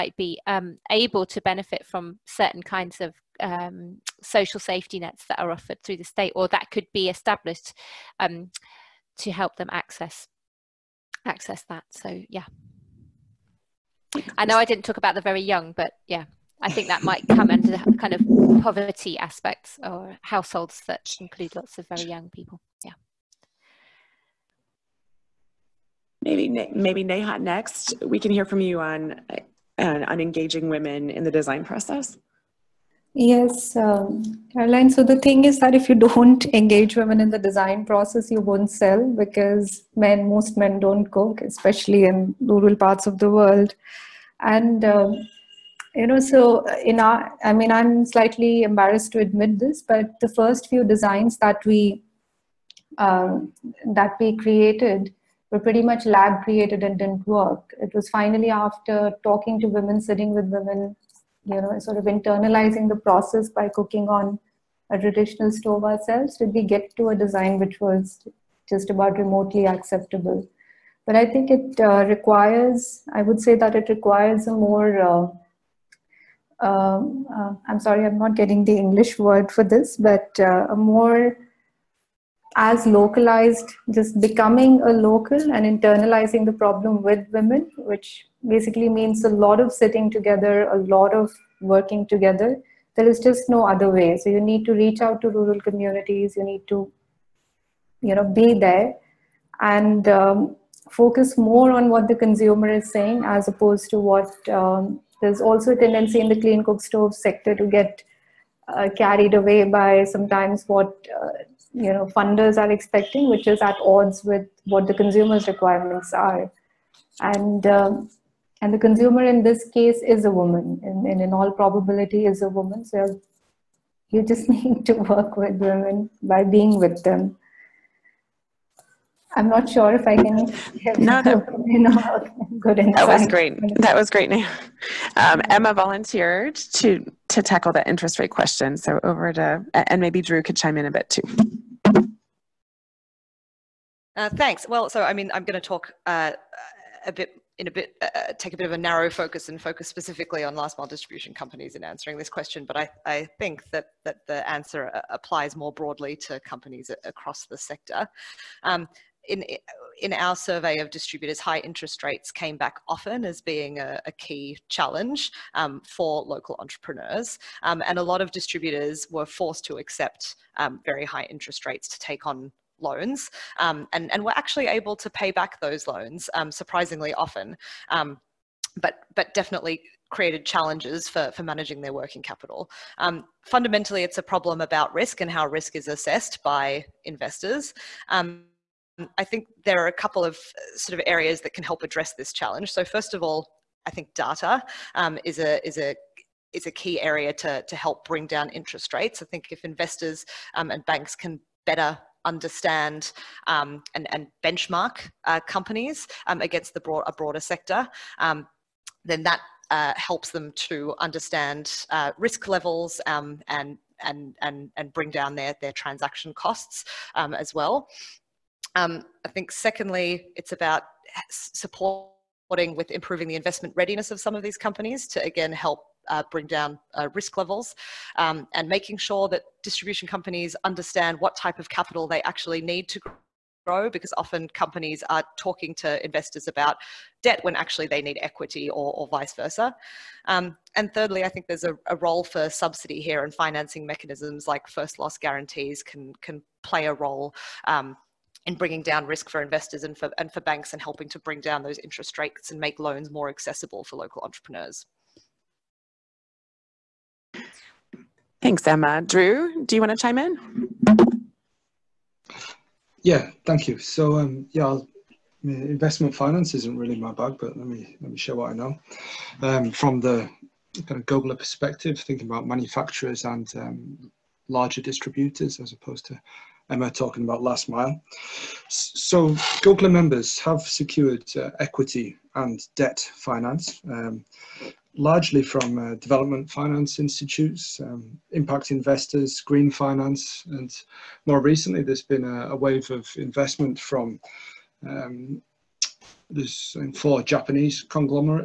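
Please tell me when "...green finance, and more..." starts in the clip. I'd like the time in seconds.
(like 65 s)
289 s.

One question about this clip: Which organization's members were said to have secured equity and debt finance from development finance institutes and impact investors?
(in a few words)
GOGLA.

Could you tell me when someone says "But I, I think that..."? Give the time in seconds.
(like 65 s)
152 s.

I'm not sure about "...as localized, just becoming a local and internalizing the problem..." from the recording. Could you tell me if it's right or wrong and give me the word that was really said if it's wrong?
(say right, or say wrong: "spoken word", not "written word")
right.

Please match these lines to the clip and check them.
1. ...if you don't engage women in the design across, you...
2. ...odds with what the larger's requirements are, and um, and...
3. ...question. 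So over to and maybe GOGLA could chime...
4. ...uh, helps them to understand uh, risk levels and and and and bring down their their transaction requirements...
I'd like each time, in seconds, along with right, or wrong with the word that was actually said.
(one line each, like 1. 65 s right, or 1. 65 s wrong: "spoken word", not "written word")
1. 35 s wrong: "process", not "across"
2. 113 s wrong: "consumer", not "larger"
3. 138 s wrong: "Drew", not "GOGLA"
4. 209 s wrong: "costs", not "requirements".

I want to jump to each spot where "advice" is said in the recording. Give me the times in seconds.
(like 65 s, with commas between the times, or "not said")
not said.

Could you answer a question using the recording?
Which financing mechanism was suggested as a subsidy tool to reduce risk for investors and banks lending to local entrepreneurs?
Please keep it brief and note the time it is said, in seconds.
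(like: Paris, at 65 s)
First loss guarantees, at 244 s.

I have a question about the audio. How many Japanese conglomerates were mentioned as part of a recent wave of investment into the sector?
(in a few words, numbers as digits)
4.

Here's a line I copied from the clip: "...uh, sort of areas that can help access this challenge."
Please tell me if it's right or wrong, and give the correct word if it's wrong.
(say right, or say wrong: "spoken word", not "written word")
wrong: "address", not "access".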